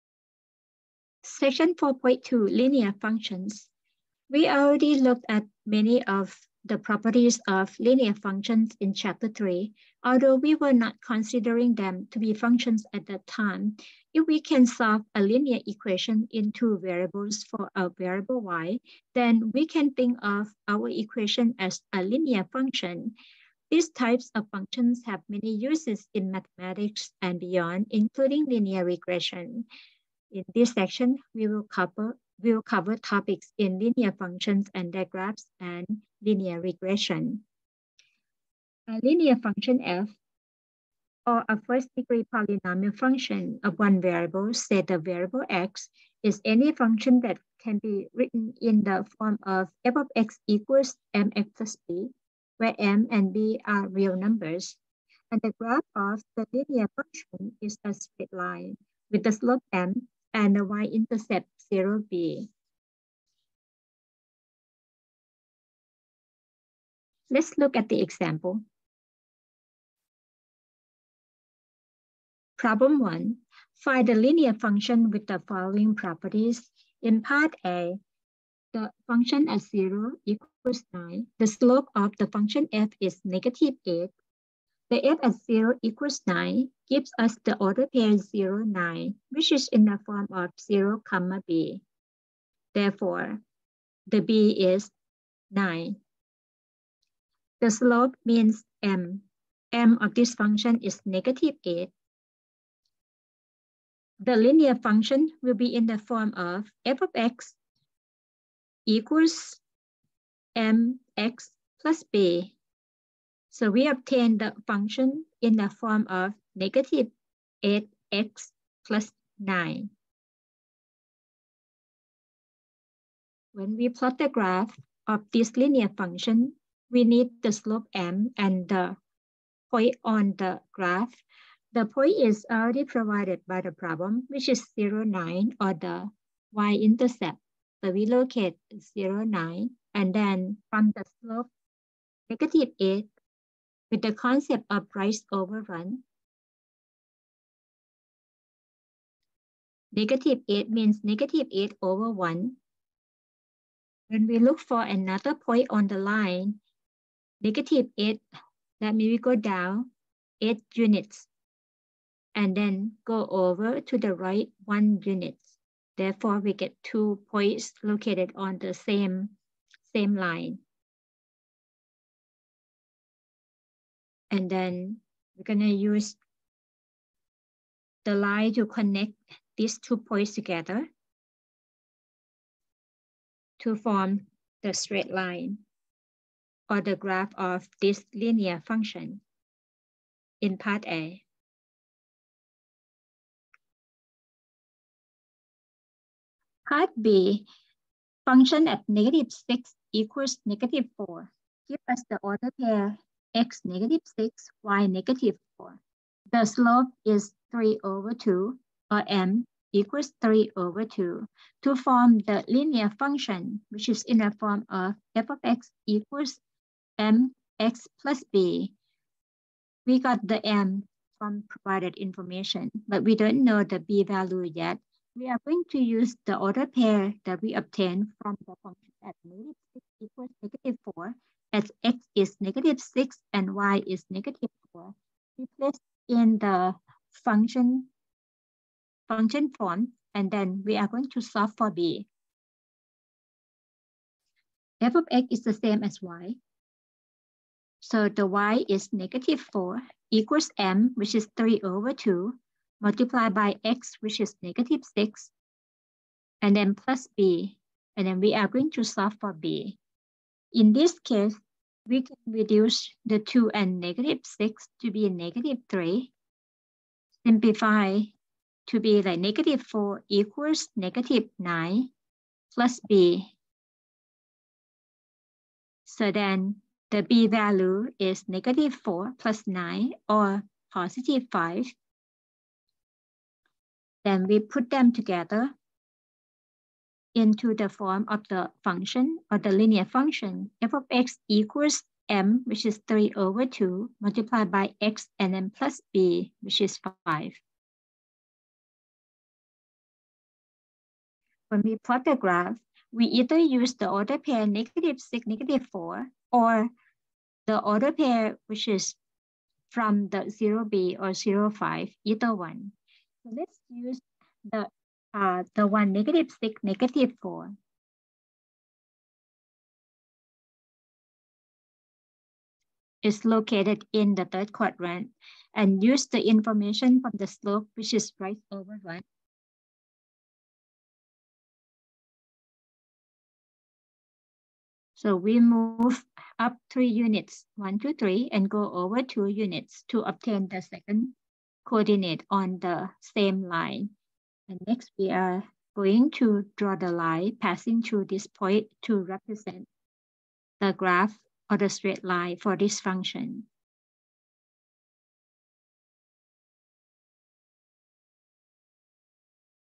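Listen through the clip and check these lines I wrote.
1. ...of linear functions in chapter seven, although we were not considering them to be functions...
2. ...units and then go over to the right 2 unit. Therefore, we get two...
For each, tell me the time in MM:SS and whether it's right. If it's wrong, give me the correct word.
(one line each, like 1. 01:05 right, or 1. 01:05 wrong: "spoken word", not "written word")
1. 00:07 wrong: "three", not "seven"
2. 02:40 wrong: "1", not "2".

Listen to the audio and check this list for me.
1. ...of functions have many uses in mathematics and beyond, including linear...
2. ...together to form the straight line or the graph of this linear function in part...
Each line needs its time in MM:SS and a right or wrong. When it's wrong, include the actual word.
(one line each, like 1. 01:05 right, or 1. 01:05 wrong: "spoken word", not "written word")
1. 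00:24 right
2. 03:00 right.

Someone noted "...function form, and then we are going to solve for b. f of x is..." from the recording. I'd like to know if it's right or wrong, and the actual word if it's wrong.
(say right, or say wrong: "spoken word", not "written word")
right.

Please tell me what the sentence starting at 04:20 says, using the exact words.
In this case, we can reduce the 2 and negative 6 to be negative 3.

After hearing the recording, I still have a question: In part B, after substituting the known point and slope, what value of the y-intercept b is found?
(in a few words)
5.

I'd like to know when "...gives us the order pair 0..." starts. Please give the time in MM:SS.
01:26.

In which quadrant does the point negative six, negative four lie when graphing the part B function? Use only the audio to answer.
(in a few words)
third quadrant.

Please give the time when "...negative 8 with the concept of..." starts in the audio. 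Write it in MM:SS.
02:22.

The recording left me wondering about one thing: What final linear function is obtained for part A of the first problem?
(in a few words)
f(x) = -8x + 9.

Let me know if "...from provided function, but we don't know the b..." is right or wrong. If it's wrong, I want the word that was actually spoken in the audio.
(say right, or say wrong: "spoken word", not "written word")
wrong: "information", not "function".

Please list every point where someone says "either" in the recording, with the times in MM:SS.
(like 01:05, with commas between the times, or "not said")
05:03, 05:12.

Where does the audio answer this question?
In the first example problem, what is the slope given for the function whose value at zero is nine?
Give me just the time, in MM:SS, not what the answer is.
01:23.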